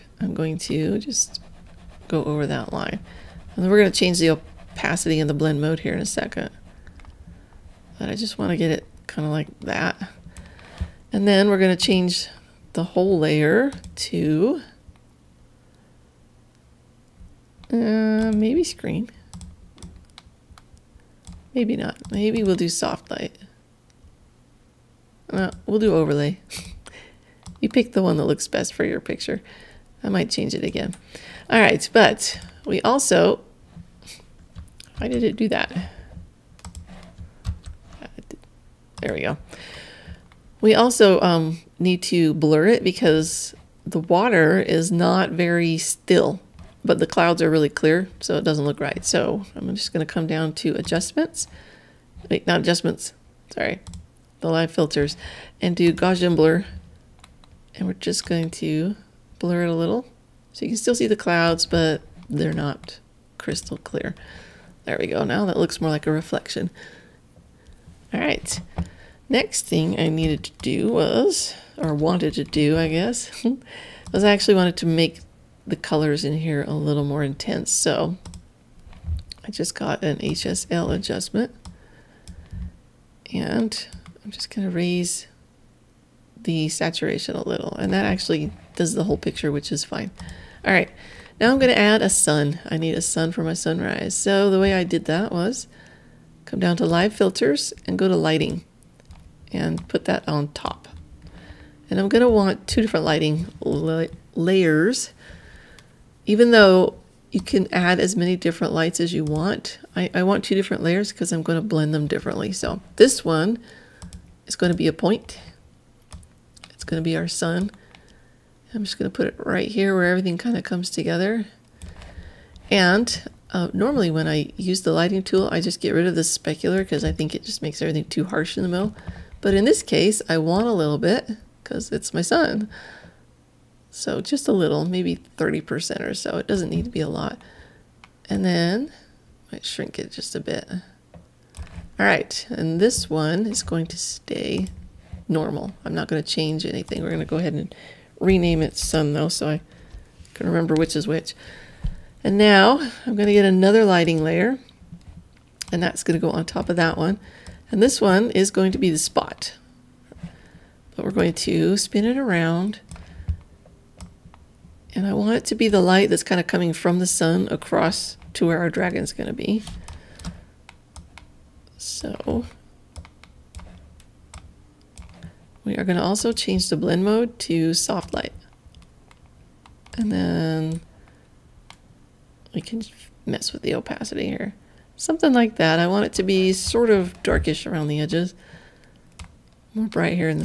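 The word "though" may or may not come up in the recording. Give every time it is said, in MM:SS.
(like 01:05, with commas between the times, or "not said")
01:46, 02:29.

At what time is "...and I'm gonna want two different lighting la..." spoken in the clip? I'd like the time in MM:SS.
01:41.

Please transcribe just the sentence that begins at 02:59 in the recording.
And then we can mess with the opacity here.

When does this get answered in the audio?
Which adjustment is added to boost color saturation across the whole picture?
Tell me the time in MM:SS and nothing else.
01:20.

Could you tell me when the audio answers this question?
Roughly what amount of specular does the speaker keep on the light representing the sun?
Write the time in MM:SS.
02:15.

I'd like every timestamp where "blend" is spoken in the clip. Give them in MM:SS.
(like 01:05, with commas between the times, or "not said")
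00:05, 01:51, 02:56.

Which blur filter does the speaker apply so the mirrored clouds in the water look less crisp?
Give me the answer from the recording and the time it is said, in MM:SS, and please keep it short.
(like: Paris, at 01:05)
Gaussian blur, at 00:55.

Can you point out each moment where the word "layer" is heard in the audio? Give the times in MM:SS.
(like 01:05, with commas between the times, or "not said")
00:13, 01:44, 01:50, 02:34.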